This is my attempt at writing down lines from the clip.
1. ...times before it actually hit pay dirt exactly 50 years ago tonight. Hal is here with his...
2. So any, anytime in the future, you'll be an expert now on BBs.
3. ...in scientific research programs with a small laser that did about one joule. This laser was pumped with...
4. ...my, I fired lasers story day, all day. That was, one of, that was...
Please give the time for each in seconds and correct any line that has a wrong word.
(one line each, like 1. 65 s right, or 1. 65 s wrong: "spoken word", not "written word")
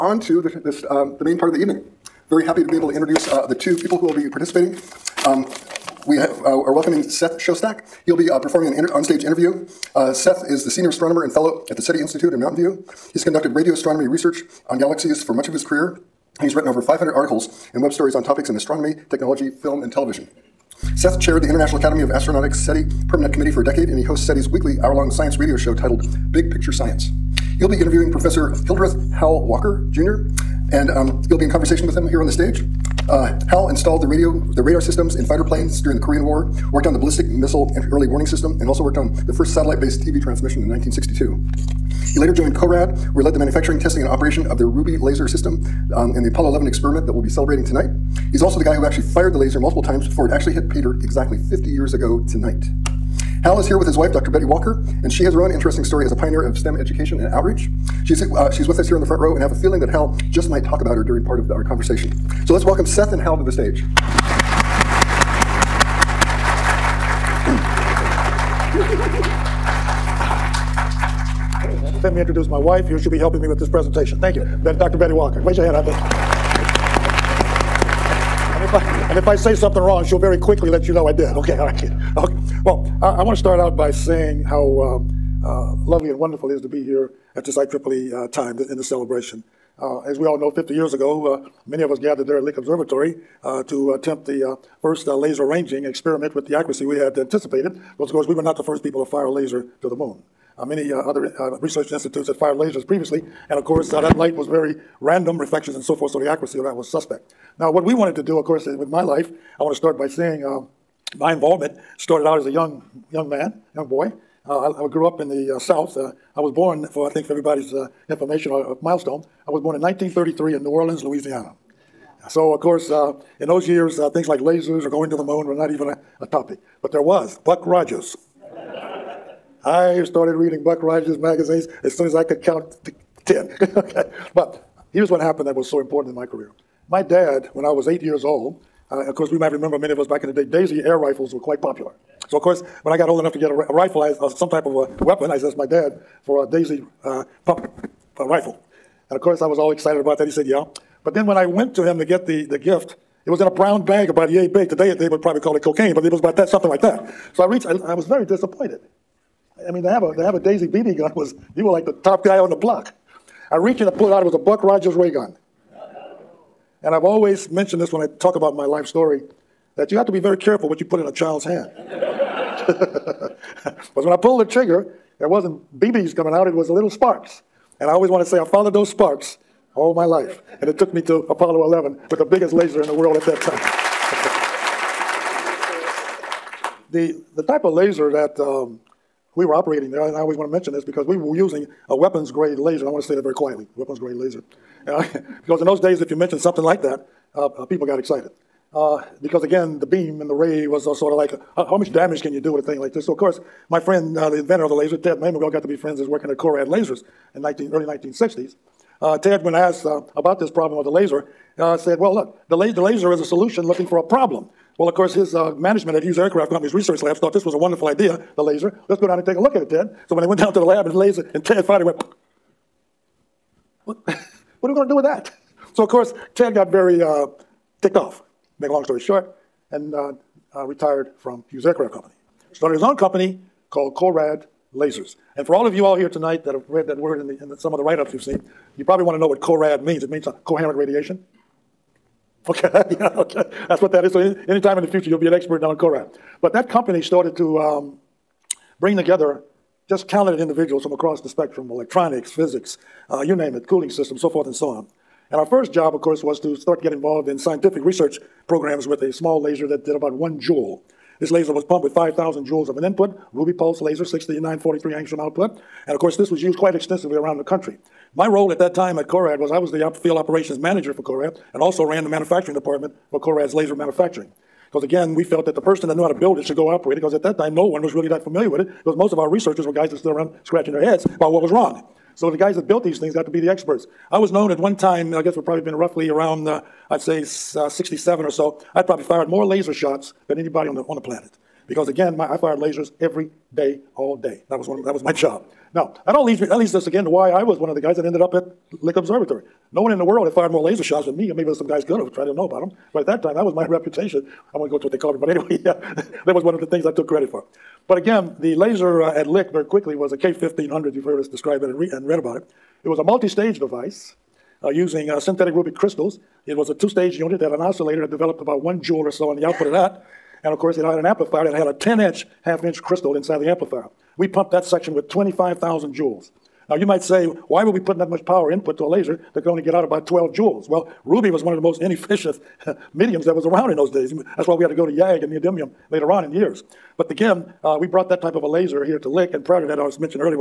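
1. 49 s right
2. 244 s wrong: "CORAD", not "BBs"
3. 257 s right
4. 292 s wrong: "every", not "story".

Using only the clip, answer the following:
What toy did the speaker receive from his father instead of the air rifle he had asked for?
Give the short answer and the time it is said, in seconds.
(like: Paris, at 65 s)
Buck Rogers ray gun, at 164 s.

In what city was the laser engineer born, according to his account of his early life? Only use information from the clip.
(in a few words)
New Orleans.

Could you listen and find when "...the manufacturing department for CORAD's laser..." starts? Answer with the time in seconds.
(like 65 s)
272 s.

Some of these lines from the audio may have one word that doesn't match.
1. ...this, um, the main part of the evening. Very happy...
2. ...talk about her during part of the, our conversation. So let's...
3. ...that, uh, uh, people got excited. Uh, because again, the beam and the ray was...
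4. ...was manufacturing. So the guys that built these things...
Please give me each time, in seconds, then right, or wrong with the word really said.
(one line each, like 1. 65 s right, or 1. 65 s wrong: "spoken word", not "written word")
1. 0 s right
2. 60 s right
3. 196 s right
4. 281 s wrong: "wrong", not "manufacturing".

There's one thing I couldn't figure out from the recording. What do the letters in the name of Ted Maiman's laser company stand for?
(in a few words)
coherent radiation.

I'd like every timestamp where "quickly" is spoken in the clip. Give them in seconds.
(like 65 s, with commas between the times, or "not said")
80 s, 309 s.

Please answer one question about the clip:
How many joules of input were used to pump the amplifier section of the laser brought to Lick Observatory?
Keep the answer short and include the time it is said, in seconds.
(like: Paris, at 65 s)
25,000 joules, at 325 s.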